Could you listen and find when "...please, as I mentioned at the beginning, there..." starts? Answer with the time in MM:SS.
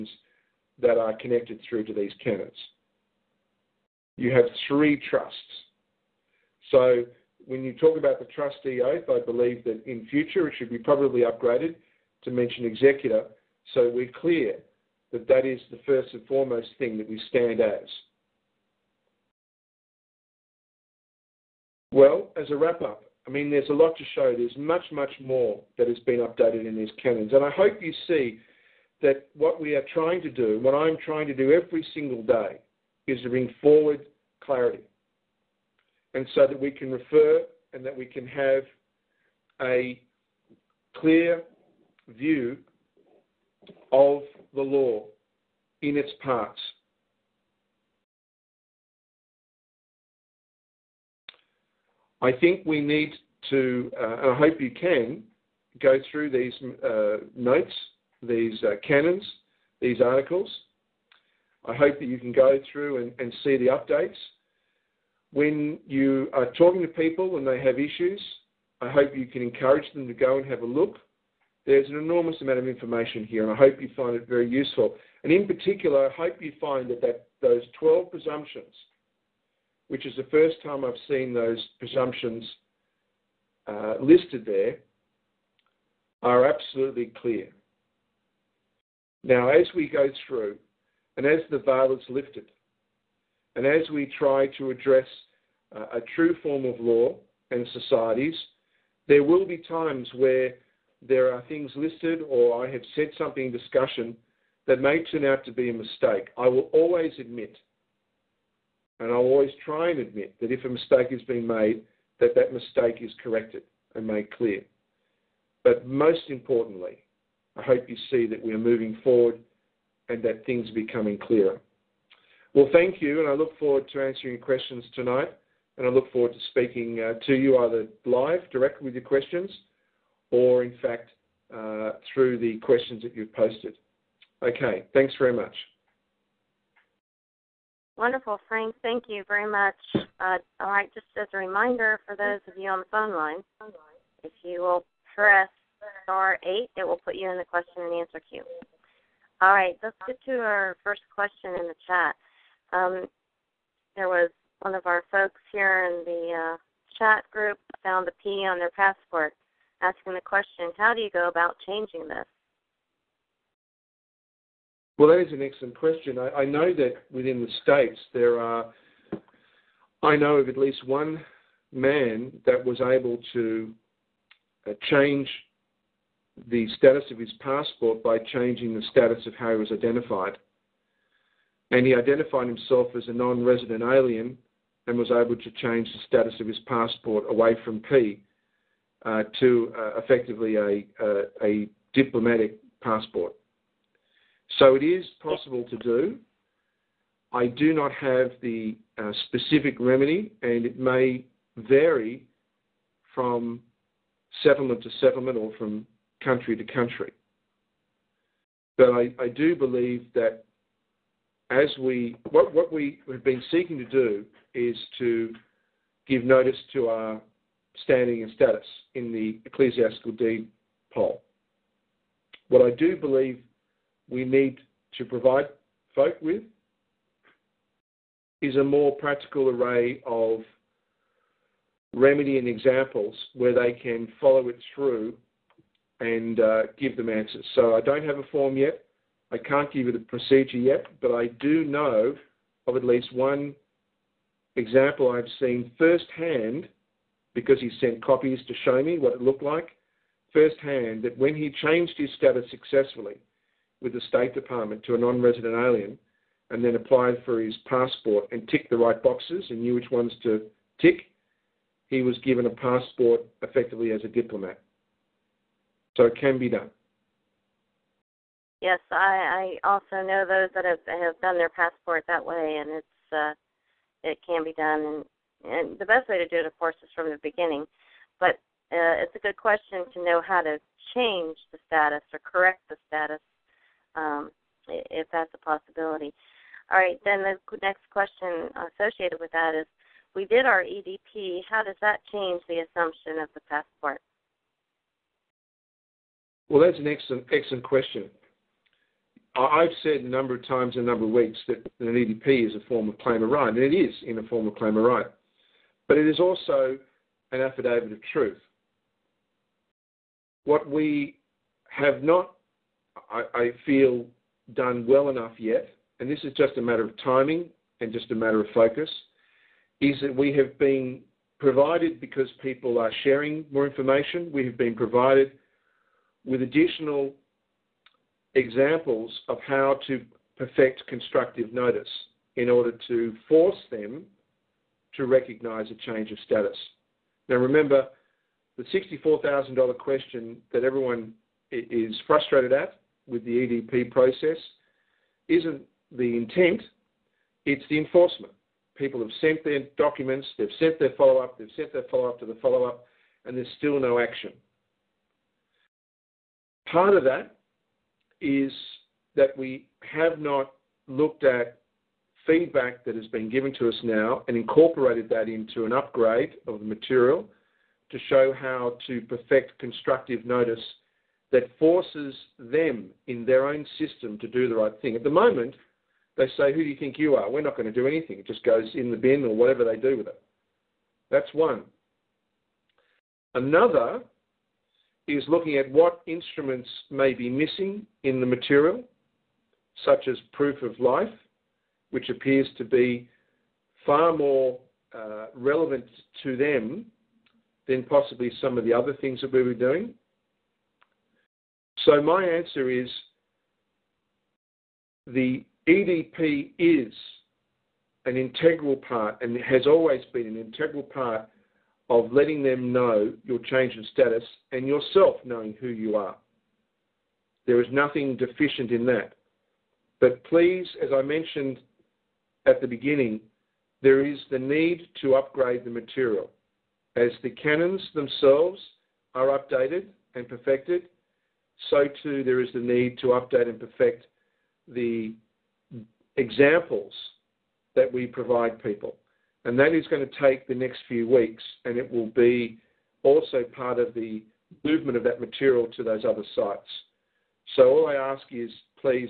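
07:00.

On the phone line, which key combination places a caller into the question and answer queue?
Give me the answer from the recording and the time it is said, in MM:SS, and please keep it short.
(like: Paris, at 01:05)
star 8, at 02:26.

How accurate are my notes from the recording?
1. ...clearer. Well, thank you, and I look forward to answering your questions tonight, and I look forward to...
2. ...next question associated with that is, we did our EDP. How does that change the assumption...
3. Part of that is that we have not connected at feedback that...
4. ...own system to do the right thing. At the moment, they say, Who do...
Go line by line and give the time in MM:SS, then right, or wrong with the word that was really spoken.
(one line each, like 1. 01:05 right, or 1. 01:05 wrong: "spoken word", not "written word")
1. 02:01 right
2. 04:47 right
3. 05:56 wrong: "looked", not "connected"
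4. 06:13 right.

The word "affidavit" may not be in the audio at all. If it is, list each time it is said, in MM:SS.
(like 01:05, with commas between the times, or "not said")
05:07.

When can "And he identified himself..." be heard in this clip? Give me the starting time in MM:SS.
03:01.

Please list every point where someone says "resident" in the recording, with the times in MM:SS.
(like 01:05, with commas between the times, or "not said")
03:03, 04:15.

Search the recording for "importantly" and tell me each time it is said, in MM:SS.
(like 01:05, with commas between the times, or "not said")
01:56.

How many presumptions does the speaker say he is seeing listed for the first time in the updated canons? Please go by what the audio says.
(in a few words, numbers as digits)
12.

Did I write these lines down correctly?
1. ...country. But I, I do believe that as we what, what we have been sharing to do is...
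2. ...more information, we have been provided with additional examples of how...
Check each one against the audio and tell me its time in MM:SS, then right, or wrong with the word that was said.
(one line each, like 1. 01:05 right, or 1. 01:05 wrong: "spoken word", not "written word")
1. 03:26 wrong: "seeking", not "sharing"
2. 05:23 right.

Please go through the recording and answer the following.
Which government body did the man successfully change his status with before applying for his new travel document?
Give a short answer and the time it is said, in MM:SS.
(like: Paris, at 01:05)
State Department, at 04:14.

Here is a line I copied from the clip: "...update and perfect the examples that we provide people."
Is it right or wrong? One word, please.
right.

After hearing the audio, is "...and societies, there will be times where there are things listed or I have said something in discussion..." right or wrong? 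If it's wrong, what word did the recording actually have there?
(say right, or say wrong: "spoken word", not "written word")
right.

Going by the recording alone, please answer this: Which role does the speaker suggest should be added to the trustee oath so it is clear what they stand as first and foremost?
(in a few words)
executor.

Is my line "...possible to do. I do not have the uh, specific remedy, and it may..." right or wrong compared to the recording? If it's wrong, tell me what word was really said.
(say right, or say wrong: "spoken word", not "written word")
right.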